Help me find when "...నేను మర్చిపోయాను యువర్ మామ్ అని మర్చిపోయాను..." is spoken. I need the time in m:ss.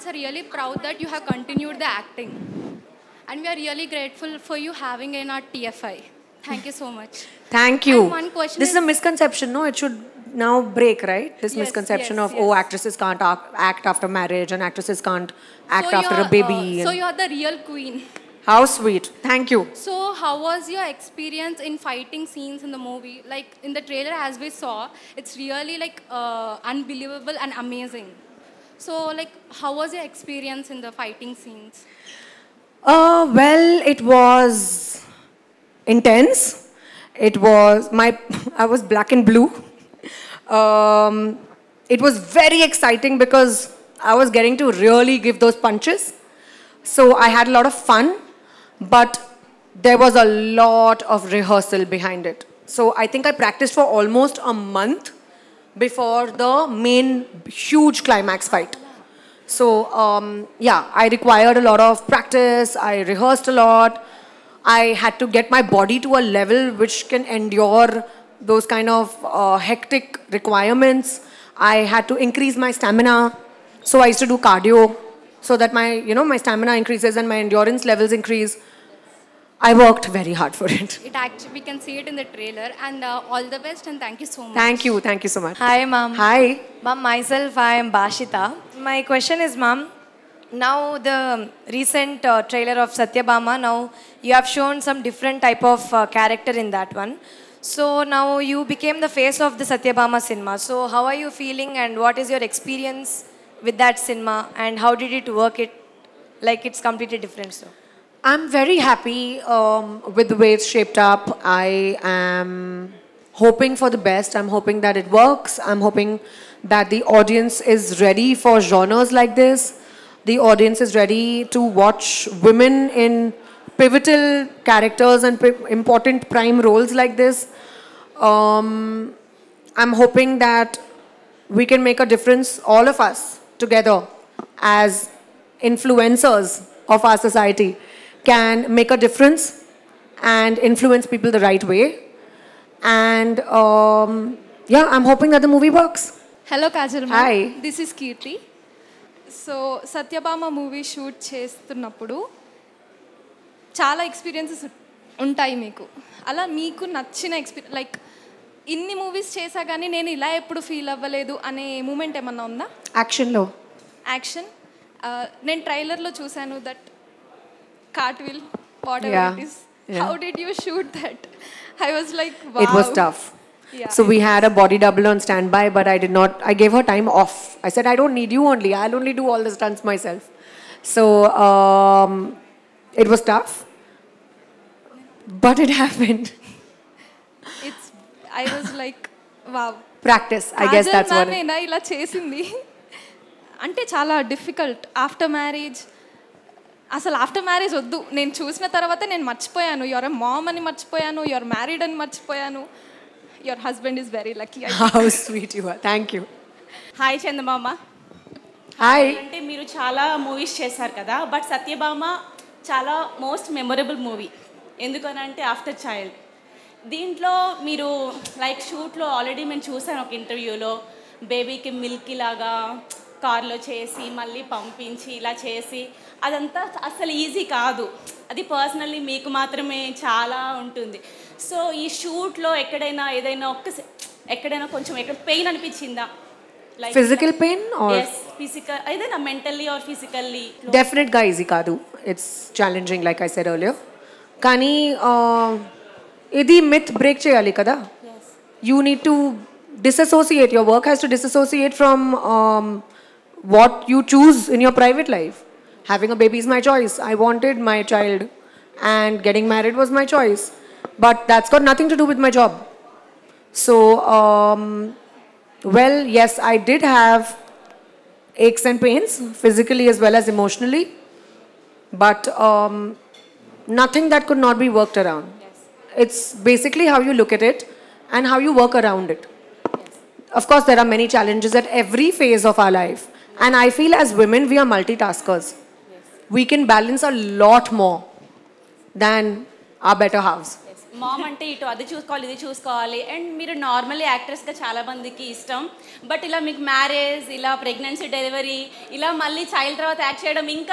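3:19.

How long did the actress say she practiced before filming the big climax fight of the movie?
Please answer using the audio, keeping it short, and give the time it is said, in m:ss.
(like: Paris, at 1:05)
almost a month, at 0:53.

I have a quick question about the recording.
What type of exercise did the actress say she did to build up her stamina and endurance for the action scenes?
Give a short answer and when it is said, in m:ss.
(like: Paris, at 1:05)
cardio, at 1:14.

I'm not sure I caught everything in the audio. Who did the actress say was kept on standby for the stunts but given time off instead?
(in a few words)
a body double.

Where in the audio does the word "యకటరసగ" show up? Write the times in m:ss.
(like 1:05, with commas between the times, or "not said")
4:54.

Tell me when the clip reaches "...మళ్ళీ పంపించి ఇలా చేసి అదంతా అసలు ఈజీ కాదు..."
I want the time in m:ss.
3:44.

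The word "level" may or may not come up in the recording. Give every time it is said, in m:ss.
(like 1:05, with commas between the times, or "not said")
1:06, 1:17.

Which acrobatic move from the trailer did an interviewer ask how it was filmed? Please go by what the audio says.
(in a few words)
cartwheel.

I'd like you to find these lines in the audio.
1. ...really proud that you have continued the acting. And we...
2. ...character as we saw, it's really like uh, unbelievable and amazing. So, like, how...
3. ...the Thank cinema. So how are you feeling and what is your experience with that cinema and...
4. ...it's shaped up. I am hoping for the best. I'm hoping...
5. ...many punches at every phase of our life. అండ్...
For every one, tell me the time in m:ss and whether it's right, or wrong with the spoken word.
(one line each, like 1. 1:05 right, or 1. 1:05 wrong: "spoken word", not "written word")
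1. 0:00 right
2. 0:23 wrong: "trailer", not "character"
3. 1:39 wrong: "Satyabhama", not "Thank"
4. 1:50 right
5. 4:40 wrong: "challenges", not "punches".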